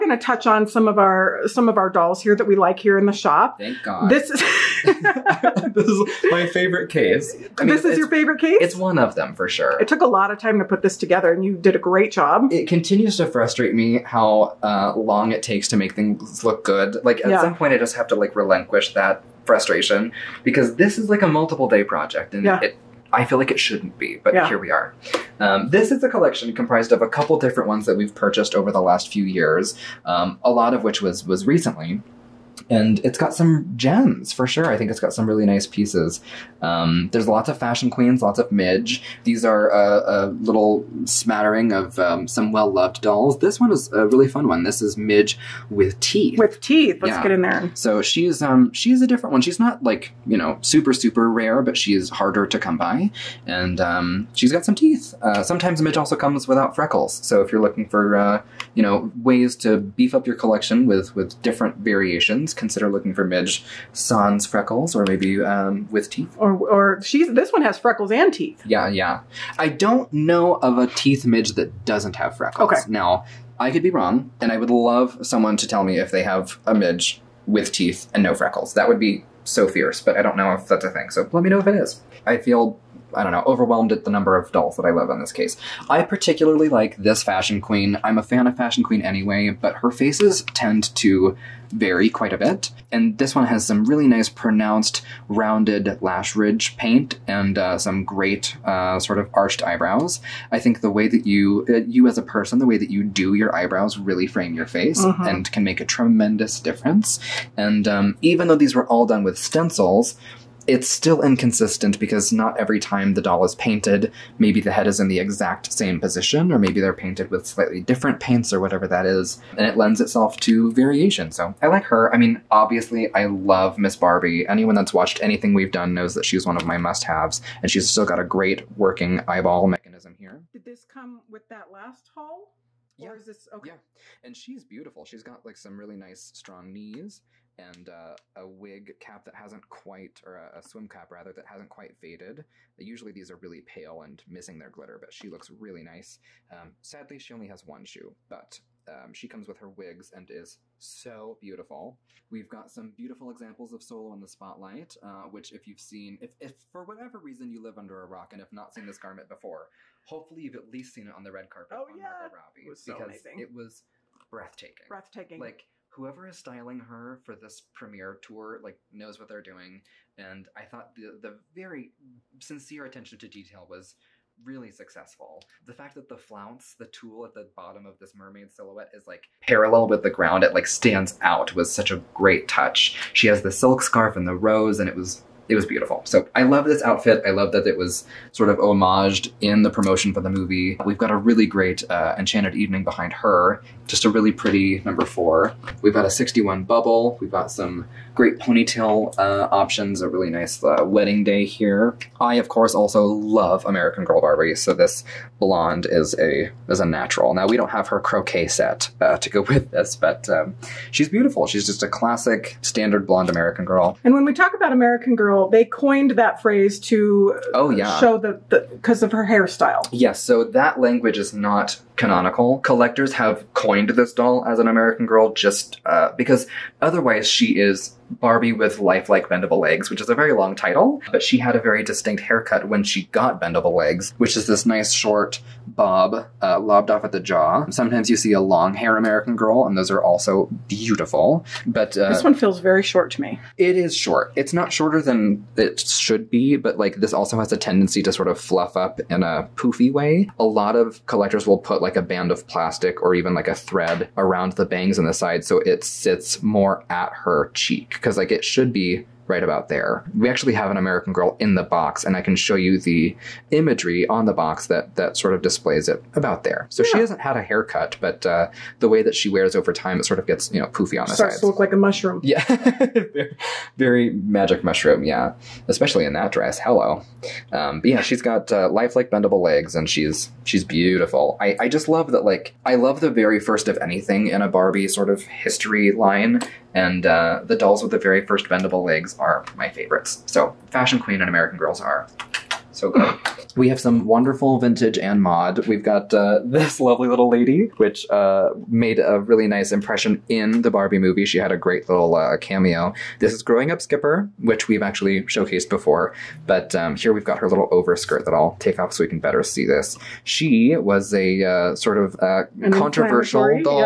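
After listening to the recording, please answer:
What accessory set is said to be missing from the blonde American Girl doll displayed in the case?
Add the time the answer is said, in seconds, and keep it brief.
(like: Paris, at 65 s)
Croquet set, at 207 s.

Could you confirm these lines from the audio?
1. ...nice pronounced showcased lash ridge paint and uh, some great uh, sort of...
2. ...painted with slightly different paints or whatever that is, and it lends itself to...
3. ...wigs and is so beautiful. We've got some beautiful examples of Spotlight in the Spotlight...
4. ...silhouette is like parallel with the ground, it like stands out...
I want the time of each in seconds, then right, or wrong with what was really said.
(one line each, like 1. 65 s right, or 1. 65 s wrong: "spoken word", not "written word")
1. 94 s wrong: "rounded", not "showcased"
2. 116 s right
3. 149 s wrong: "Solo", not "Spotlight"
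4. 178 s right.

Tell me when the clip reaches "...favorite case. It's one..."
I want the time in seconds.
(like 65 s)
8 s.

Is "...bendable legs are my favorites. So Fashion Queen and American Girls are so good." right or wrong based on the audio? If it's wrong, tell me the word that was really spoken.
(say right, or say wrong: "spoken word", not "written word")
right.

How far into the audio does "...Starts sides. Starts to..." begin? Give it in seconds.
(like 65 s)
271 s.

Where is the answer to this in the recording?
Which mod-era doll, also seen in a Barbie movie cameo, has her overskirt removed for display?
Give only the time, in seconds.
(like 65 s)
303 s.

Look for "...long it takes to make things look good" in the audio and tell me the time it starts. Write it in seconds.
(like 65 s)
14 s.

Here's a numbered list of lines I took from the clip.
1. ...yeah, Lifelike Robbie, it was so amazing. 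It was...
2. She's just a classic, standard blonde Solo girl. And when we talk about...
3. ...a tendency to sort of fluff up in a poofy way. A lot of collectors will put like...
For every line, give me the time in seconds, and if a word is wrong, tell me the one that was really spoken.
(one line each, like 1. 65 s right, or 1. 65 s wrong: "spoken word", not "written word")
1. 161 s wrong: "Margot", not "Lifelike"
2. 211 s wrong: "American", not "Solo"
3. 247 s right.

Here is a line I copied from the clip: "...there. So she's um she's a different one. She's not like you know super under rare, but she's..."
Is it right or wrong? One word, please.
wrong.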